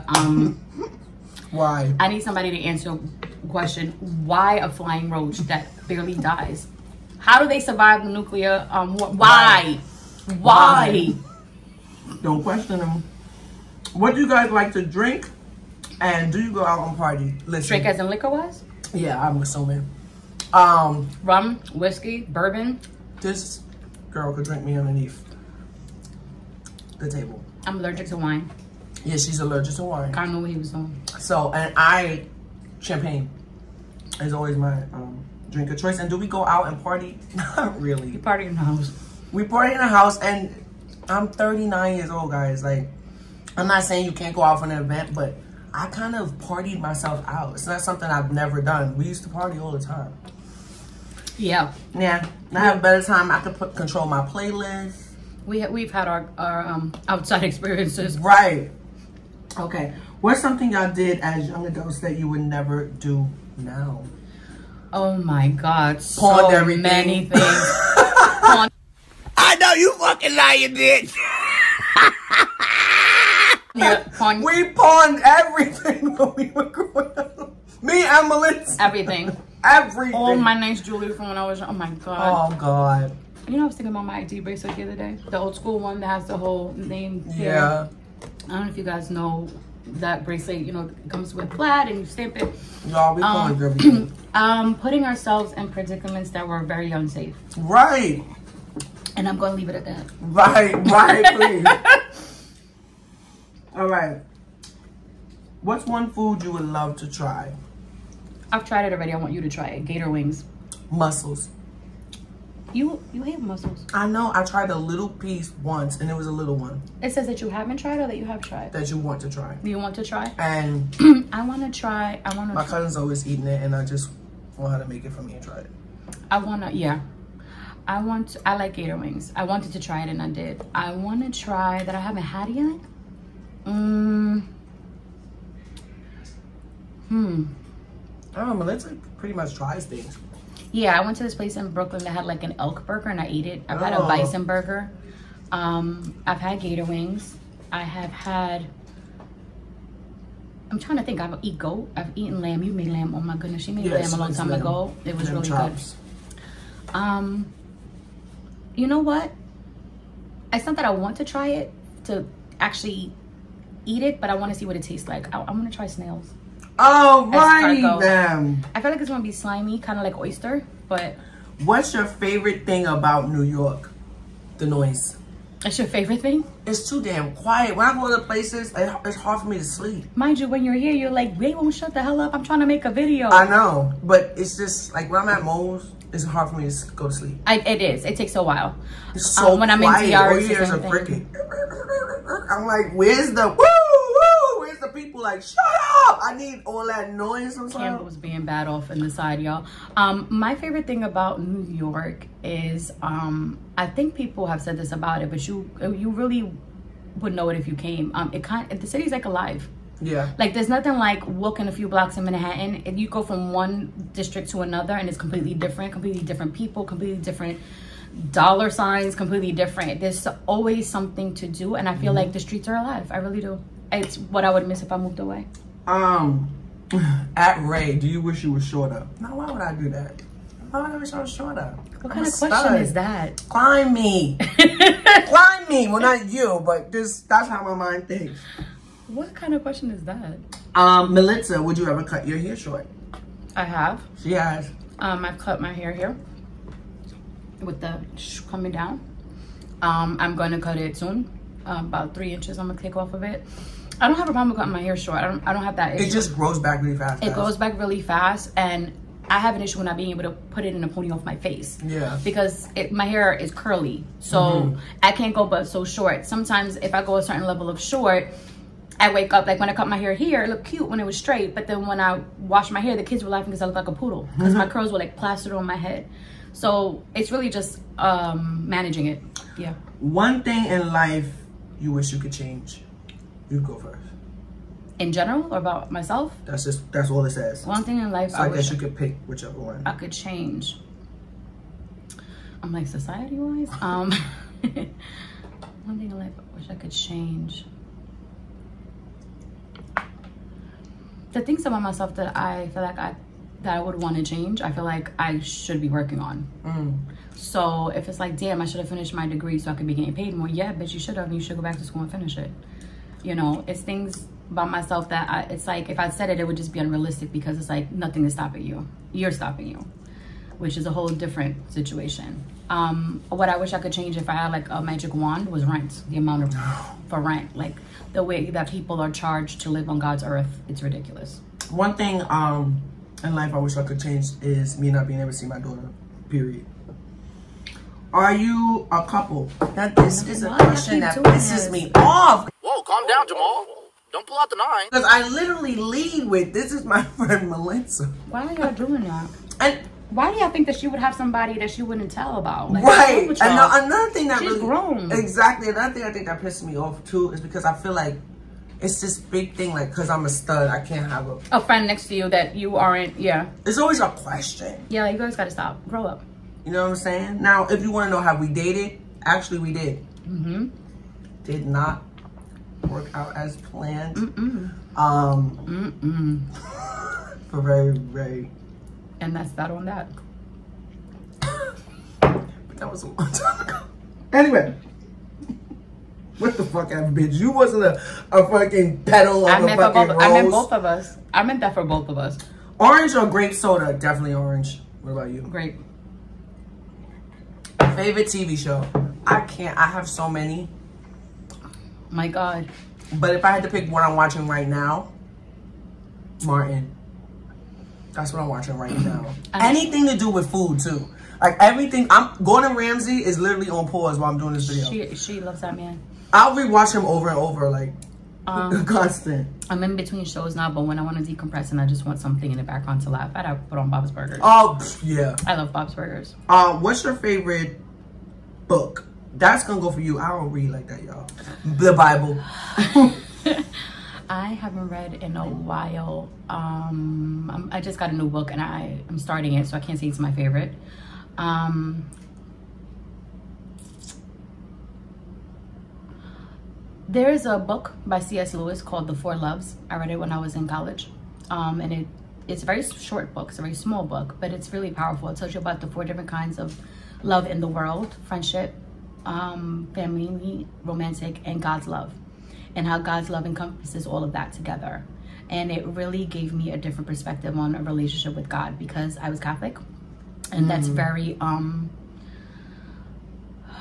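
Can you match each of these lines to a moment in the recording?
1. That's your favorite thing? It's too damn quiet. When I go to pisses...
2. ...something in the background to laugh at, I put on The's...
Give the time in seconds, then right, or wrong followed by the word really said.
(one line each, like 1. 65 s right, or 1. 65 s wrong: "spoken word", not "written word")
1. 175 s wrong: "places", not "pisses"
2. 422 s wrong: "Bob", not "The".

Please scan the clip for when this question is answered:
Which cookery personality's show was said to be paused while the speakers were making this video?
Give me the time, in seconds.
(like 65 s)
412 s.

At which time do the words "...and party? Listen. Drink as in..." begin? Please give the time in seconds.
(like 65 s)
16 s.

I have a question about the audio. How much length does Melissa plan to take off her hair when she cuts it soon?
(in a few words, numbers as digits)
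3 inches.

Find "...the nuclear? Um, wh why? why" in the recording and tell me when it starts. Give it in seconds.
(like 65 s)
8 s.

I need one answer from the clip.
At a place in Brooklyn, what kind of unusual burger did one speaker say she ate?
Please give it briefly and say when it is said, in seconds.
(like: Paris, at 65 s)
Elk burger, at 142 s.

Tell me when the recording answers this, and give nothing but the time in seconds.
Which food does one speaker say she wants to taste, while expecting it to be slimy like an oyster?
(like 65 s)
165 s.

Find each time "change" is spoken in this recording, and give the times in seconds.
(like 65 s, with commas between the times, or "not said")
282 s, 290 s, 296 s, 304 s, 323 s, 334 s.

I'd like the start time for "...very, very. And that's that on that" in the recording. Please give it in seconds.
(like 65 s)
377 s.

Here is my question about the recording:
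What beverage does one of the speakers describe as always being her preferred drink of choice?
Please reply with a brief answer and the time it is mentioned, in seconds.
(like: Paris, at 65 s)
Champagne, at 32 s.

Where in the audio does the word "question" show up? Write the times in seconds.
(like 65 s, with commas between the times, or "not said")
3 s, 12 s, 232 s, 239 s, 340 s, 364 s.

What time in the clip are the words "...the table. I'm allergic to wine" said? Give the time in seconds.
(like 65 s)
26 s.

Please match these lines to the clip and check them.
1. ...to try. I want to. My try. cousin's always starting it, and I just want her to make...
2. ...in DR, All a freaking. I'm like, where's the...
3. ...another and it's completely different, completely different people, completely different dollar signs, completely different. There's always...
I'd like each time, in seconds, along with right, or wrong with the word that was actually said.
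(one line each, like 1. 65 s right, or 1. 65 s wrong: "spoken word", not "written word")
1. 121 s wrong: "eating", not "starting"
2. 190 s right
3. 214 s right.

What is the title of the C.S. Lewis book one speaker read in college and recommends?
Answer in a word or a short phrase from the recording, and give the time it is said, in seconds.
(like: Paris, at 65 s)
The Four Loves, at 449 s.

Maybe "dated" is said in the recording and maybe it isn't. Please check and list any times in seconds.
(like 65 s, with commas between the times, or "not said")
368 s.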